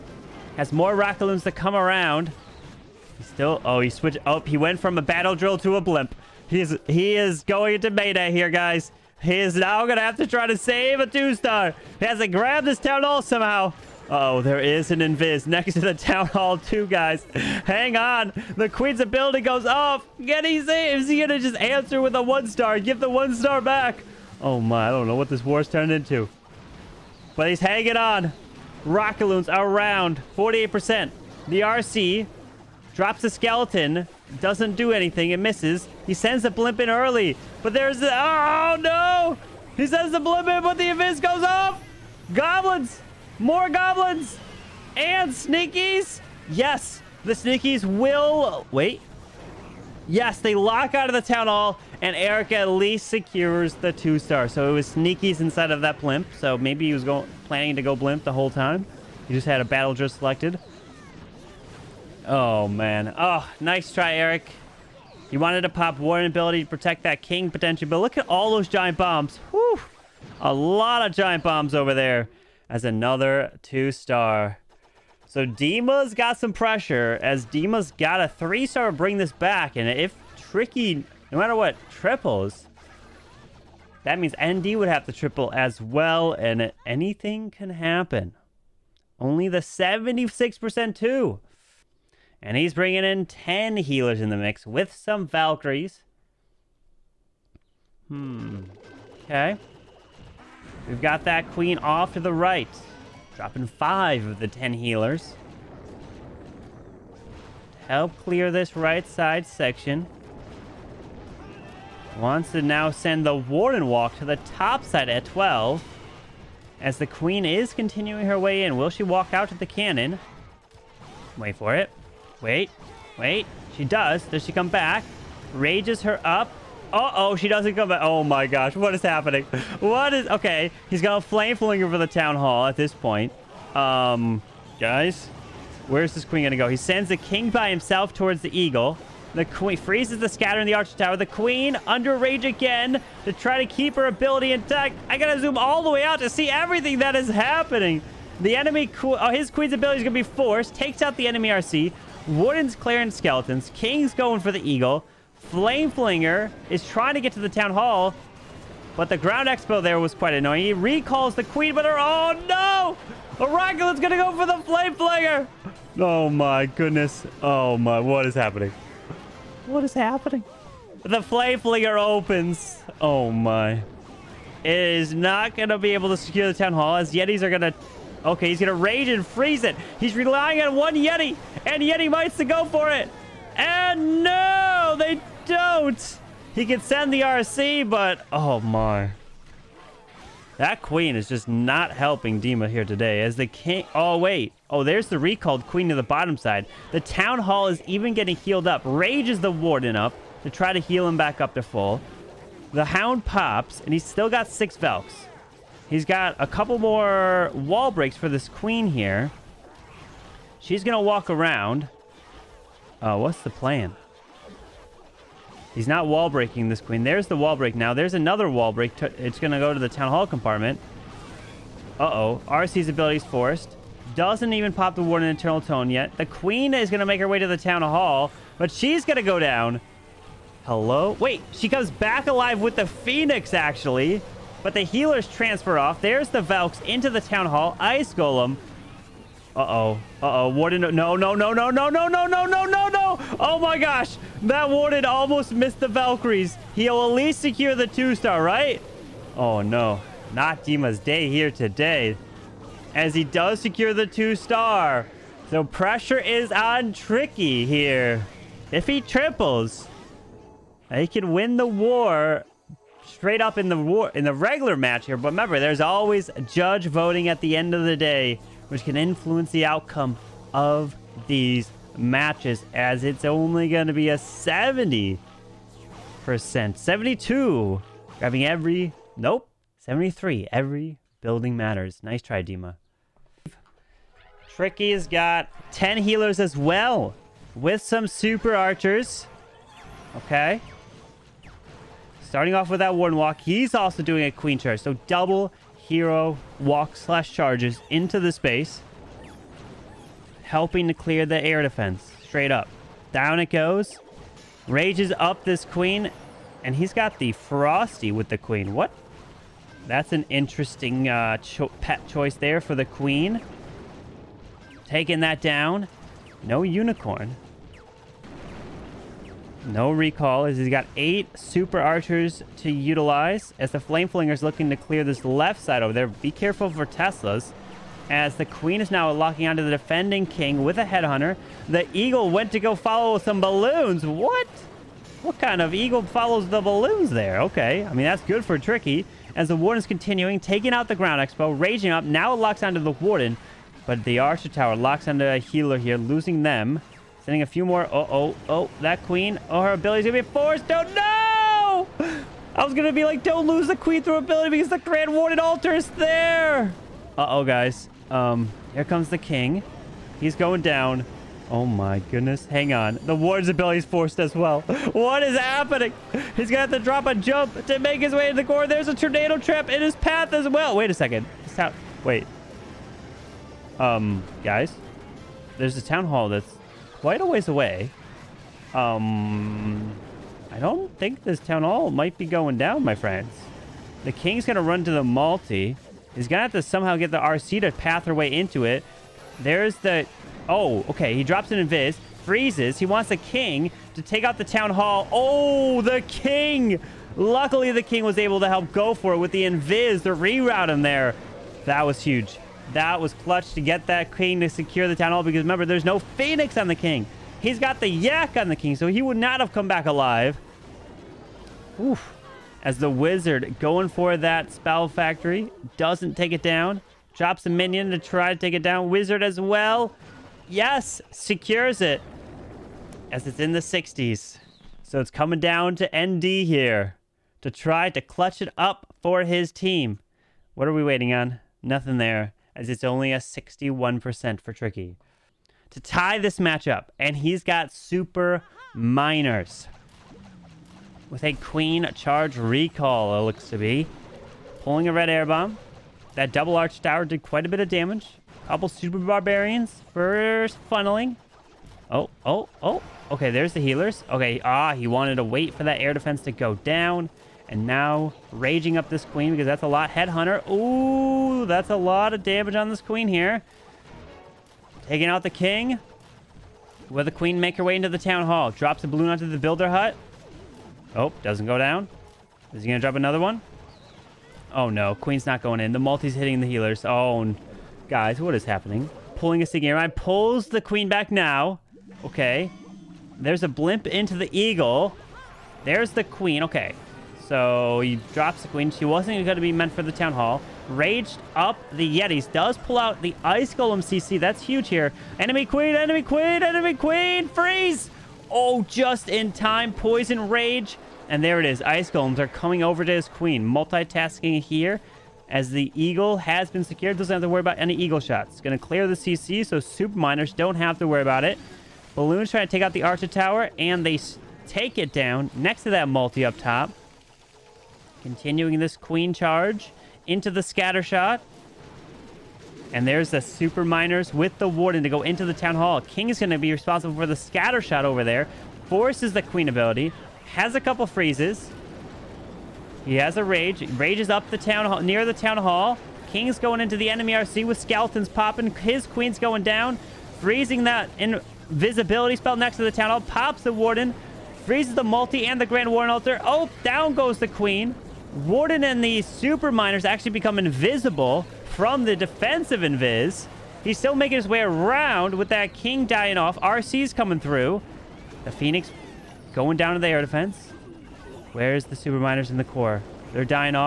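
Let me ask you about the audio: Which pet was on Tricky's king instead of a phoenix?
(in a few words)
Yak.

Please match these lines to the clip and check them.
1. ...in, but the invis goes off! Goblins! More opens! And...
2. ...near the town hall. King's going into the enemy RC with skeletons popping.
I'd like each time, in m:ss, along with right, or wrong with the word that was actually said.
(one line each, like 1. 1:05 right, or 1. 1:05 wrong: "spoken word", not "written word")
1. 0:40 wrong: "goblins", not "opens"
2. 8:54 right.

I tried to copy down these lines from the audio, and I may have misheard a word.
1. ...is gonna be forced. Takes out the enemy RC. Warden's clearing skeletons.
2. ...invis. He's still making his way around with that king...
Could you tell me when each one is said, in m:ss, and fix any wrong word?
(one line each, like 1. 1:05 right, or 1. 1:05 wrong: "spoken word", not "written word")
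1. 2:29 right
2. 9:12 right.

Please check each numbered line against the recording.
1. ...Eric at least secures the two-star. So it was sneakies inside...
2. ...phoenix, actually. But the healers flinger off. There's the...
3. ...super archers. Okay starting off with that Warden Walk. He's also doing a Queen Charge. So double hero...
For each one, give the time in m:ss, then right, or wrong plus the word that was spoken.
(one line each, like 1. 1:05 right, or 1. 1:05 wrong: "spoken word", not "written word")
1. 0:52 right
2. 3:52 wrong: "transfer", not "flinger"
3. 4:48 right.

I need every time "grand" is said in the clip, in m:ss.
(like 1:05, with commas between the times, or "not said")
5:54, 9:05.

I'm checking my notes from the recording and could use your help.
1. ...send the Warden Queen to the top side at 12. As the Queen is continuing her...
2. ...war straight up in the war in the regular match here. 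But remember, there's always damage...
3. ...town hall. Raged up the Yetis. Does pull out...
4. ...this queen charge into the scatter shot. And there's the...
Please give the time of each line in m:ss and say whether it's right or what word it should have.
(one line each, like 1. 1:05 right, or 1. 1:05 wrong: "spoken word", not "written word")
1. 1:52 wrong: "Walk", not "Queen"
2. 4:21 wrong: "judge", not "damage"
3. 8:09 right
4. 8:38 right.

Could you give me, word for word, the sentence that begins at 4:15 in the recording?
So pressure is on Tricky here.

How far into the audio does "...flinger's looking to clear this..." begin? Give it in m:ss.
5:24.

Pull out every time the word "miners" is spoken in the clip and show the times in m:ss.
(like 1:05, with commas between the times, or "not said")
7:18, 8:29, 8:43, 9:09, 9:21.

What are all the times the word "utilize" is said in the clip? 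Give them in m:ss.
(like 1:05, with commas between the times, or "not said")
5:22.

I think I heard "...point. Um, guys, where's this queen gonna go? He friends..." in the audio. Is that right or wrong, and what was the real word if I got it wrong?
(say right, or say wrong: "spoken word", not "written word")
wrong: "sends", not "friends".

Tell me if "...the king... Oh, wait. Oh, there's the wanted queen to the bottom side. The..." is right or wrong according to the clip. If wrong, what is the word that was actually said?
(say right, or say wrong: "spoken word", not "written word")
wrong: "recalled", not "wanted".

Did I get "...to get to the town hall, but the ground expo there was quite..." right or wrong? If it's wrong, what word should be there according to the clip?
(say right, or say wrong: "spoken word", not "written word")
right.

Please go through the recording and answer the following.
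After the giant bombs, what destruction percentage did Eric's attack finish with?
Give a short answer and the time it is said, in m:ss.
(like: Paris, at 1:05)
76%, at 1:29.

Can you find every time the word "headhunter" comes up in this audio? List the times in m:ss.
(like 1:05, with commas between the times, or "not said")
5:30, 7:39.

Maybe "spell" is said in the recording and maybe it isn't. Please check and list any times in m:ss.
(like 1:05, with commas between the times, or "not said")
6:54, 9:02.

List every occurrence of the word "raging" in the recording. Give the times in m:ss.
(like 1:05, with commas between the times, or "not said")
5:41, 7:38.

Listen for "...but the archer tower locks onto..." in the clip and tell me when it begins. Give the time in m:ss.
5:43.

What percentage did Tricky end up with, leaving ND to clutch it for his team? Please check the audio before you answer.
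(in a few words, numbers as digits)
61%.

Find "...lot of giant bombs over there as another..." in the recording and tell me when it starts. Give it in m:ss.
1:10.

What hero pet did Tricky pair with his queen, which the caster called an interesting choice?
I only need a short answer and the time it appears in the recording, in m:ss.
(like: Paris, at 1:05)
Frosty, at 5:07.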